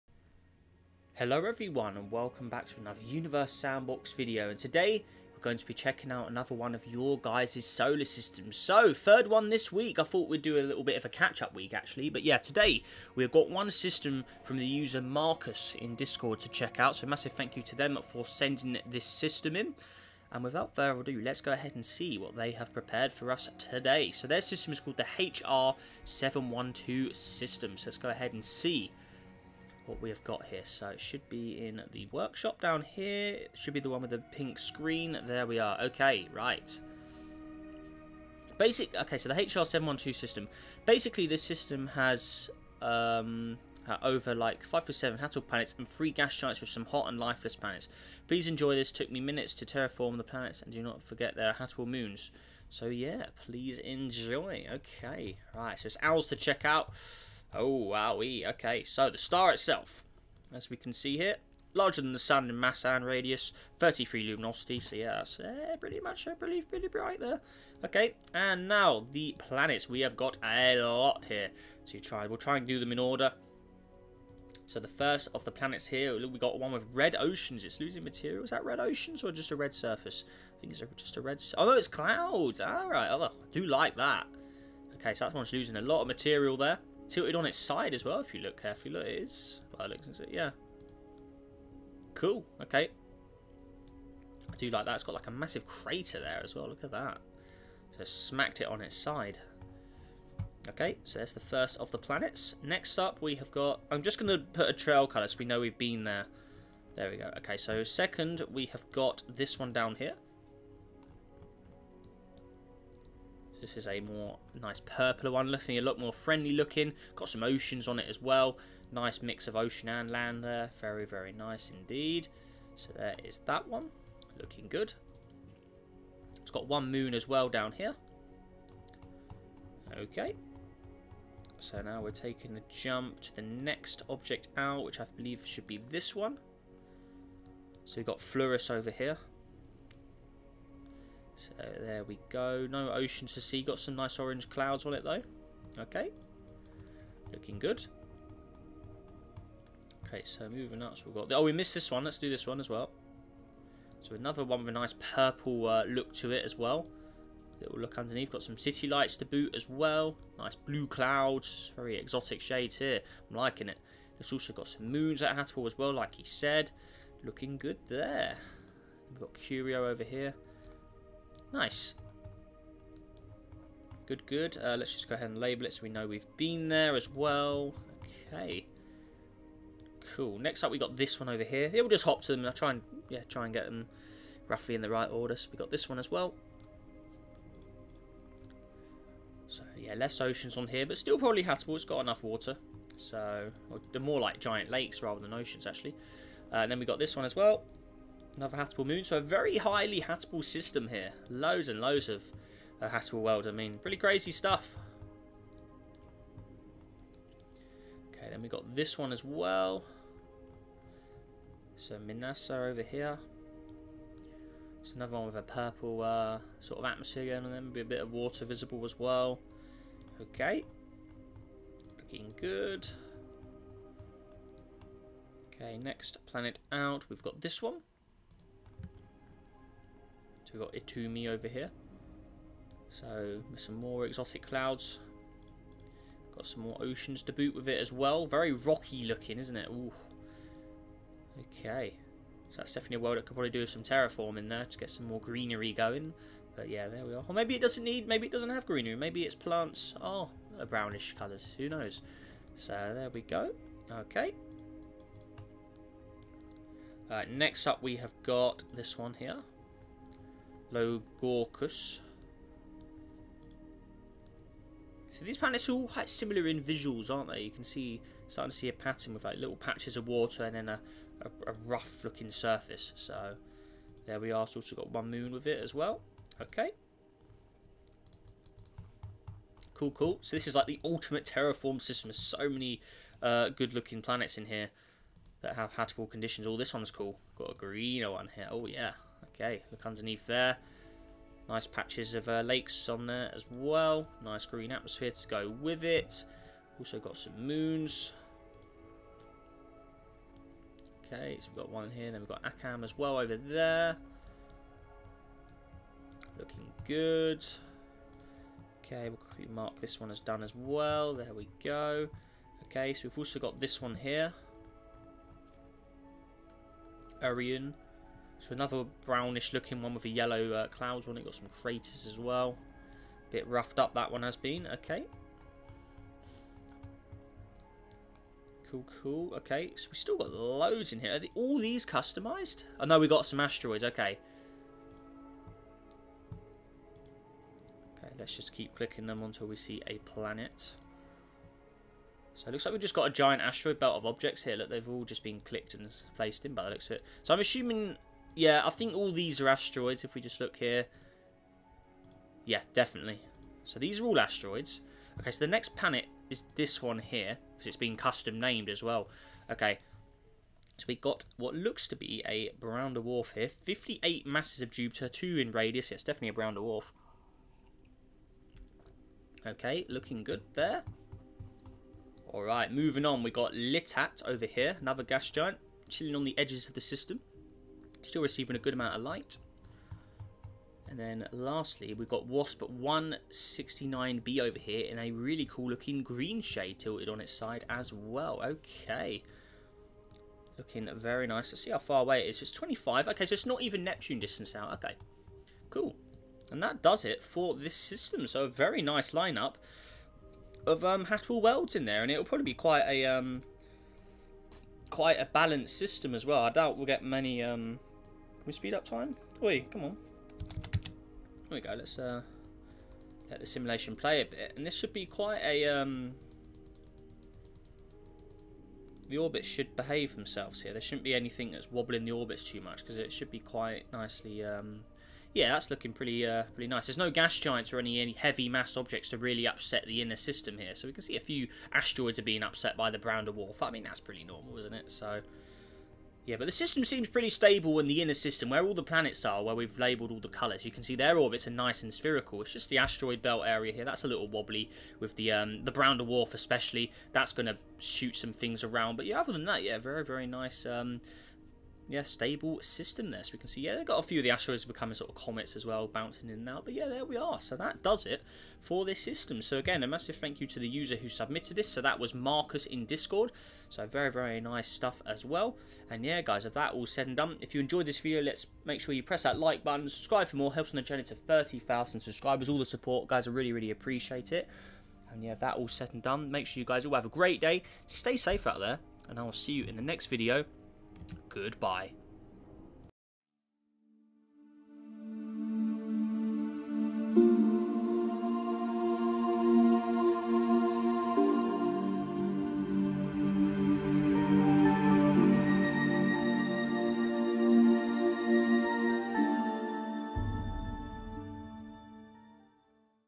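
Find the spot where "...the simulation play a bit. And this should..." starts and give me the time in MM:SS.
06:53.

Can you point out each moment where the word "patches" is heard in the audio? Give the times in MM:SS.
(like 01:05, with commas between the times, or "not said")
04:29, 04:51.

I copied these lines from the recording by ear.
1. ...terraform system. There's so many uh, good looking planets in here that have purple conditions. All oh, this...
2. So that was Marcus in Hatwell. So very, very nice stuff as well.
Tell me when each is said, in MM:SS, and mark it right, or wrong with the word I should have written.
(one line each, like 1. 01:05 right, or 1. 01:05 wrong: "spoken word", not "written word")
1. 04:41 wrong: "habitable", not "purple"
2. 07:41 wrong: "Discord", not "Hatwell".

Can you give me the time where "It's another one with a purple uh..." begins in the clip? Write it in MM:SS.
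03:34.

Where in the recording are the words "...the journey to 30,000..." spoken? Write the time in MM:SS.
07:50.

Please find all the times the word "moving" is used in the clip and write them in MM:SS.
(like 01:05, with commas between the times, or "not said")
02:30, 06:12.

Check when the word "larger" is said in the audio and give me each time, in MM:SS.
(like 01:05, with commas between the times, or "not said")
01:01.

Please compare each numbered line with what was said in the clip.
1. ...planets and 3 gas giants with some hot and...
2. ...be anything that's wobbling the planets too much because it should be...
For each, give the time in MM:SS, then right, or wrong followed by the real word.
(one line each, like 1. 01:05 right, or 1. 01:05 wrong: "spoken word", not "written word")
1. 00:45 right
2. 07:01 wrong: "orbits", not "planets".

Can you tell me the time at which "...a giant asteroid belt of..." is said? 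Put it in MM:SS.
05:43.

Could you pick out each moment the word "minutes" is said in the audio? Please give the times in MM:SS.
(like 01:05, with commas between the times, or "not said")
00:49.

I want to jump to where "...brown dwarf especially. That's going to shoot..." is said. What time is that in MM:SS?
07:25.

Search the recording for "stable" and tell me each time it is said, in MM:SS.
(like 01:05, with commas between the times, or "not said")
07:17, 07:32.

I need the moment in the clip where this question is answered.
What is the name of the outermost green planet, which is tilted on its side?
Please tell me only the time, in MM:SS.
06:22.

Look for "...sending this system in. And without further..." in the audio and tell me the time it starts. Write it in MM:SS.
00:18.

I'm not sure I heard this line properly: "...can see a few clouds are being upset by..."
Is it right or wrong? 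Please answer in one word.
wrong.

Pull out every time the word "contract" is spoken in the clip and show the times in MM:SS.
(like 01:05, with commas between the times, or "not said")
not said.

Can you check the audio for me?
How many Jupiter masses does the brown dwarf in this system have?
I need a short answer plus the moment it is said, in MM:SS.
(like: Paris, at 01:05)
58, at 06:03.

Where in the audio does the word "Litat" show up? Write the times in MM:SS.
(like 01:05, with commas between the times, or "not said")
06:13.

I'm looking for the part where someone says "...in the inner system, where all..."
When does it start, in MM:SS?
07:17.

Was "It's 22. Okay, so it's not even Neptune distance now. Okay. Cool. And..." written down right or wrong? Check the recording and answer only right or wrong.
wrong.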